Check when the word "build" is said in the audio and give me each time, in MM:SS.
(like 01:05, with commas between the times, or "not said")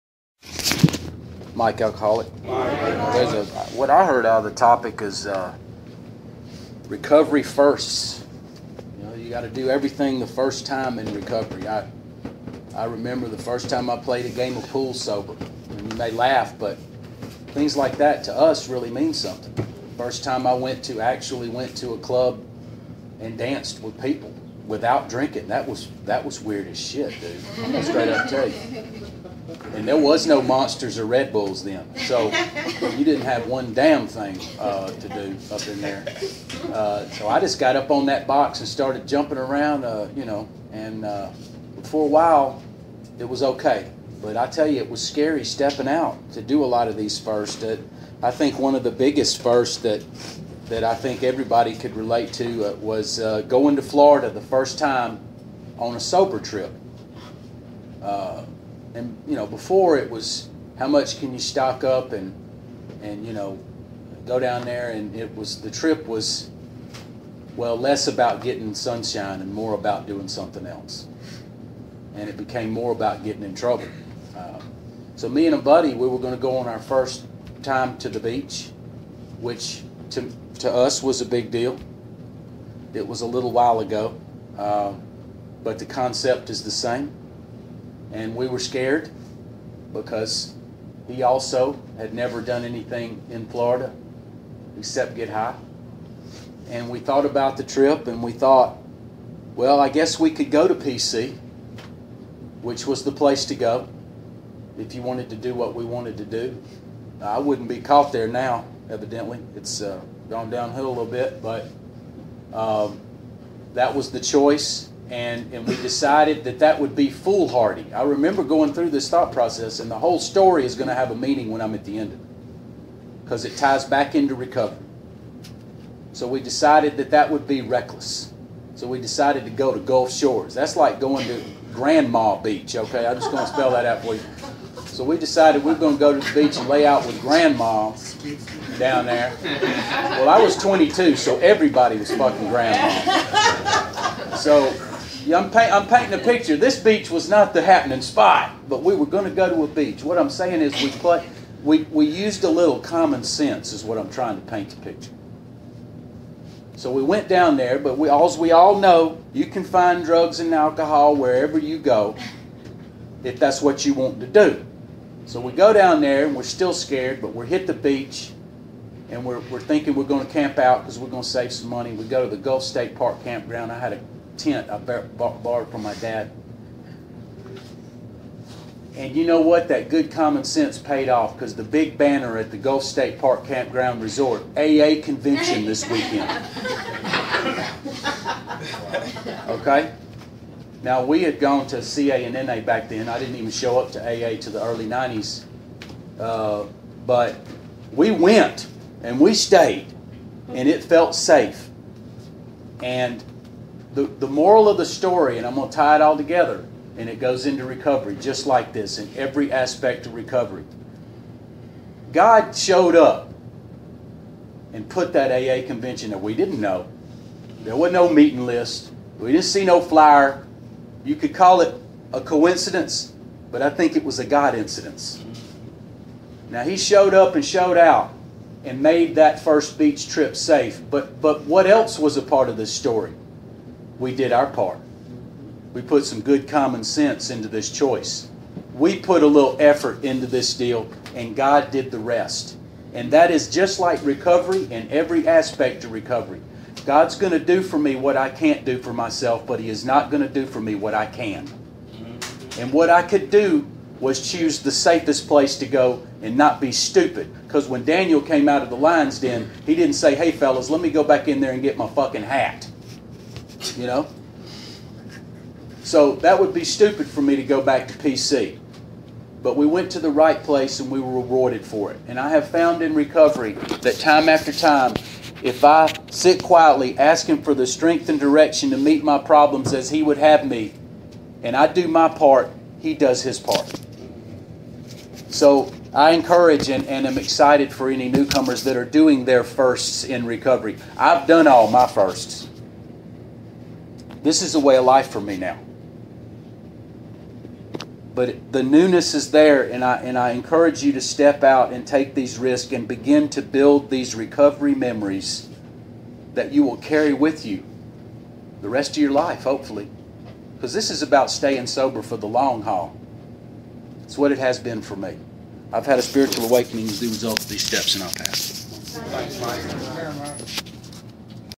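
05:03.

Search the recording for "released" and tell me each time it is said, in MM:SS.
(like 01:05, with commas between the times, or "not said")
not said.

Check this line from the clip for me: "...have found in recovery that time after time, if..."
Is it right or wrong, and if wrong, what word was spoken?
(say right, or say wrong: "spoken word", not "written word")
right.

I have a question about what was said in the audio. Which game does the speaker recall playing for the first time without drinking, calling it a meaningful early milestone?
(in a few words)
pool.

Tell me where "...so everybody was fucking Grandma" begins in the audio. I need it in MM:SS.
02:21.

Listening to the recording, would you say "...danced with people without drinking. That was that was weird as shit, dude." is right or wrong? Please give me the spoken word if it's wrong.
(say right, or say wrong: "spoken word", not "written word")
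right.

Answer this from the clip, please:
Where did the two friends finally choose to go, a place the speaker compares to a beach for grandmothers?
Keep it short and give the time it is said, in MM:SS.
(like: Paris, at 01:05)
Gulf Shores, at 02:09.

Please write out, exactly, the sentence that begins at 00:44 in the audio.
But I tell you, it was scary stepping out to do a lot of these first.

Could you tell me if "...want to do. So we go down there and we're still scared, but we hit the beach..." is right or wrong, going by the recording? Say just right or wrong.
right.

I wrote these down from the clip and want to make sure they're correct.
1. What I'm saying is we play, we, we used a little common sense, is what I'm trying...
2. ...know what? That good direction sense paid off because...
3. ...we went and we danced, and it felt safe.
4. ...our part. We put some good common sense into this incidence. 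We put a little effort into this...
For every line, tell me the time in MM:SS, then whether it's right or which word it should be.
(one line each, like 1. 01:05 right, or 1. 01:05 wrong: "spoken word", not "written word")
1. 02:30 right
2. 02:59 wrong: "common", not "direction"
3. 03:17 wrong: "stayed", not "danced"
4. 03:54 wrong: "choice", not "incidence".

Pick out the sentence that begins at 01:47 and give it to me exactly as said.
I wouldn't be caught there now, evidently.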